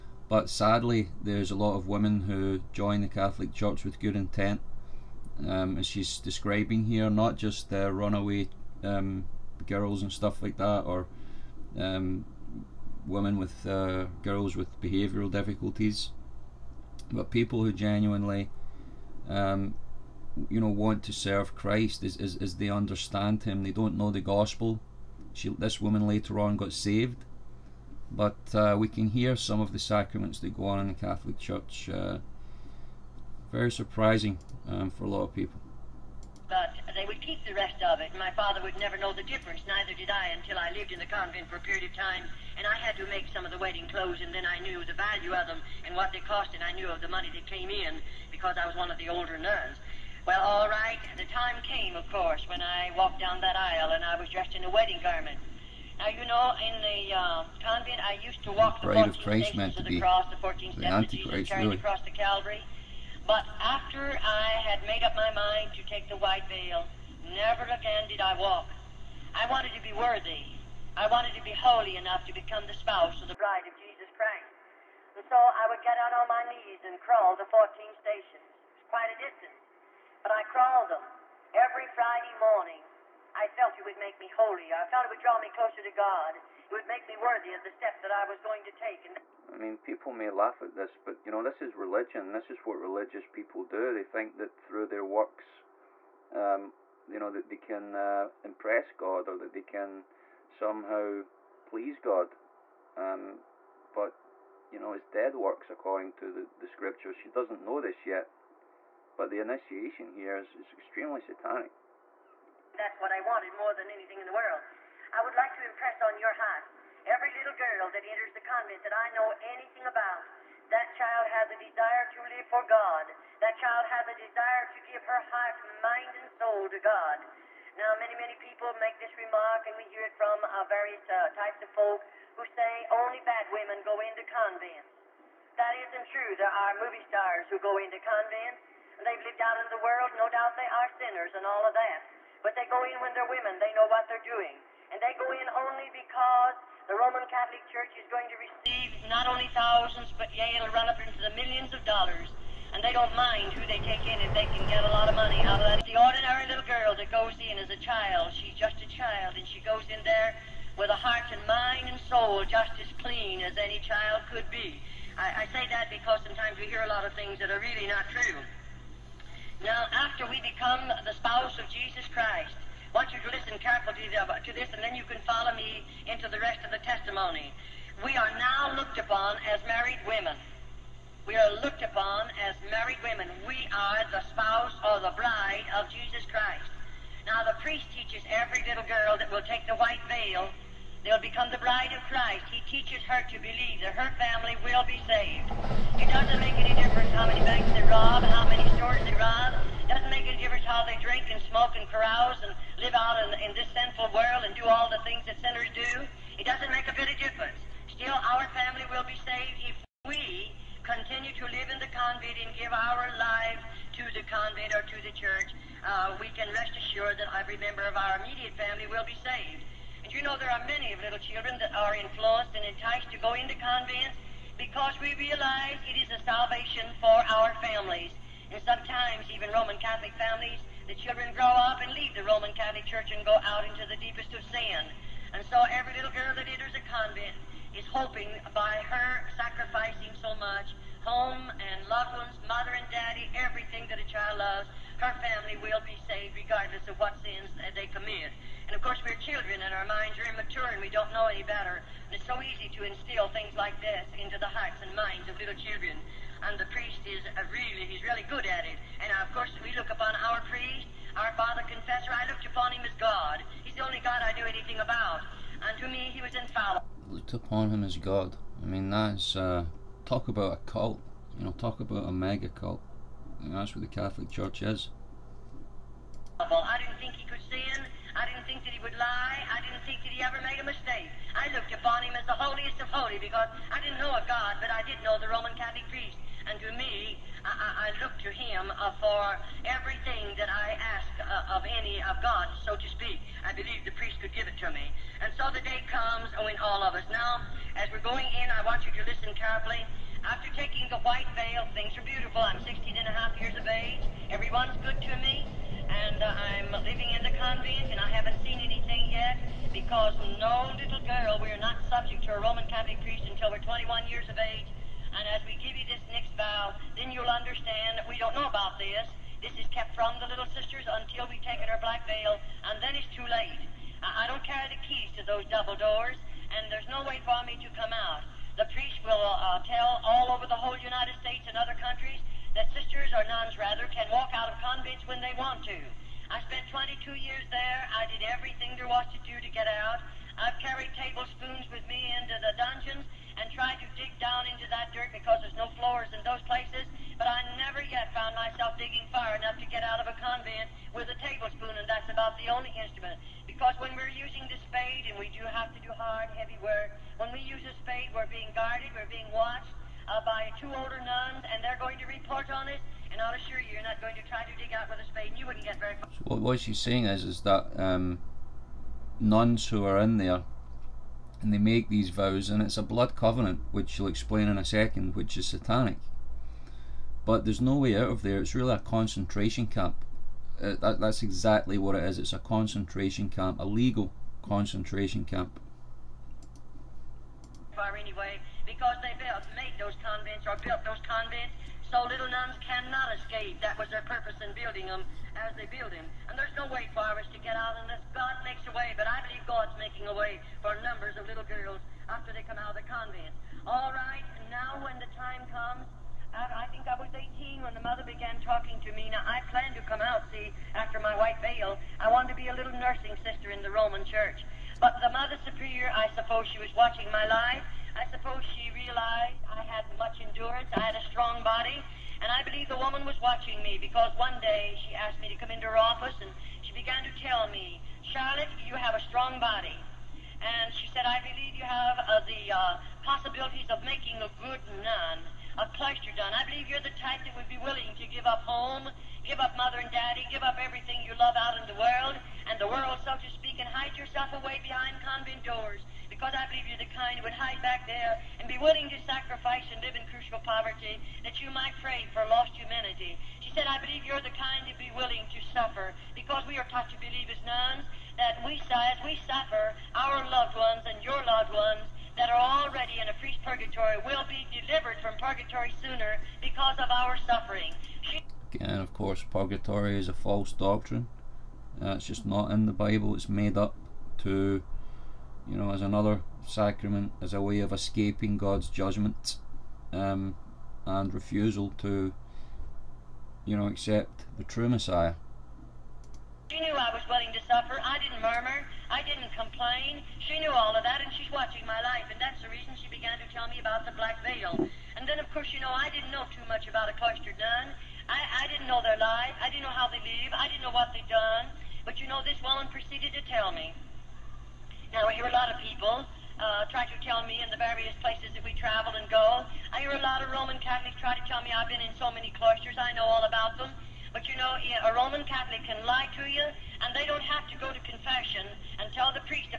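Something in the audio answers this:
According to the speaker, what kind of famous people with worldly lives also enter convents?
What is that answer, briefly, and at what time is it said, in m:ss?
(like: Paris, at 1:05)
Movie stars, at 2:16.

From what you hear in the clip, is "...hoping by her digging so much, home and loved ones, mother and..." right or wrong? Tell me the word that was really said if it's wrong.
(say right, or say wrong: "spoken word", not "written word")
wrong: "sacrificing", not "digging".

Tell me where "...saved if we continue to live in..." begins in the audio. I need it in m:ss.
3:29.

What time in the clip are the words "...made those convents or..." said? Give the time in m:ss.
6:29.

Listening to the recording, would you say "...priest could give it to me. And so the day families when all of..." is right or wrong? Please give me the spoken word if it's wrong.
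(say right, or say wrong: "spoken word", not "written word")
wrong: "comes", not "families".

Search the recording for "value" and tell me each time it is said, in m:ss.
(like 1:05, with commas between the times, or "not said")
0:44.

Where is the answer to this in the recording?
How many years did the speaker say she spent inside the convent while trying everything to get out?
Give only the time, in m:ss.
5:36.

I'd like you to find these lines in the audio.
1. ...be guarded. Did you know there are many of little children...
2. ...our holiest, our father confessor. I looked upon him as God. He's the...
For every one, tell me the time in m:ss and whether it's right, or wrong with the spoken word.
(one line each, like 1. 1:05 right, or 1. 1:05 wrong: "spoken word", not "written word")
1. 3:39 wrong: "saved", not "guarded"
2. 4:20 wrong: "priest", not "holiest".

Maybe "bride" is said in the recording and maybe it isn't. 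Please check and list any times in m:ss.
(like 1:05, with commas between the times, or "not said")
1:13, 3:05, 3:11.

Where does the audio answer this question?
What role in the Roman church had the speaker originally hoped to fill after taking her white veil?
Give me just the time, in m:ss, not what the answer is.
6:52.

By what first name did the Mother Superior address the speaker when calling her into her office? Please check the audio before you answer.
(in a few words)
Charlotte.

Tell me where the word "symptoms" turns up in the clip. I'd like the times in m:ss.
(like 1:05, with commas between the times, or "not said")
not said.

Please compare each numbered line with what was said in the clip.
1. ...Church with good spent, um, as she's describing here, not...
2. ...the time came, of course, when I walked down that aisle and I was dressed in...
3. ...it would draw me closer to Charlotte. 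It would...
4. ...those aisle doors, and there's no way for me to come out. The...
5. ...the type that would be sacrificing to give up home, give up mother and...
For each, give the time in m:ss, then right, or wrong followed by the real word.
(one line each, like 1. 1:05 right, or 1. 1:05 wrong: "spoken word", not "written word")
1. 0:03 wrong: "intent", not "spent"
2. 0:51 right
3. 1:25 wrong: "God", not "Charlotte"
4. 5:25 wrong: "double", not "aisle"
5. 7:16 wrong: "willing", not "sacrificing".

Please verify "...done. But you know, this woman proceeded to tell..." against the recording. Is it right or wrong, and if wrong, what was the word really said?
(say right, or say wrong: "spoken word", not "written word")
right.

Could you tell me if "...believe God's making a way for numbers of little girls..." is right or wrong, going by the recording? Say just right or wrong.
right.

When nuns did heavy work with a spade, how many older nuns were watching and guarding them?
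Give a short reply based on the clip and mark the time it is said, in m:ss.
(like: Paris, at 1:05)
2, at 6:00.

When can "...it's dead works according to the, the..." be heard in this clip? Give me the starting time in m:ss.
1:44.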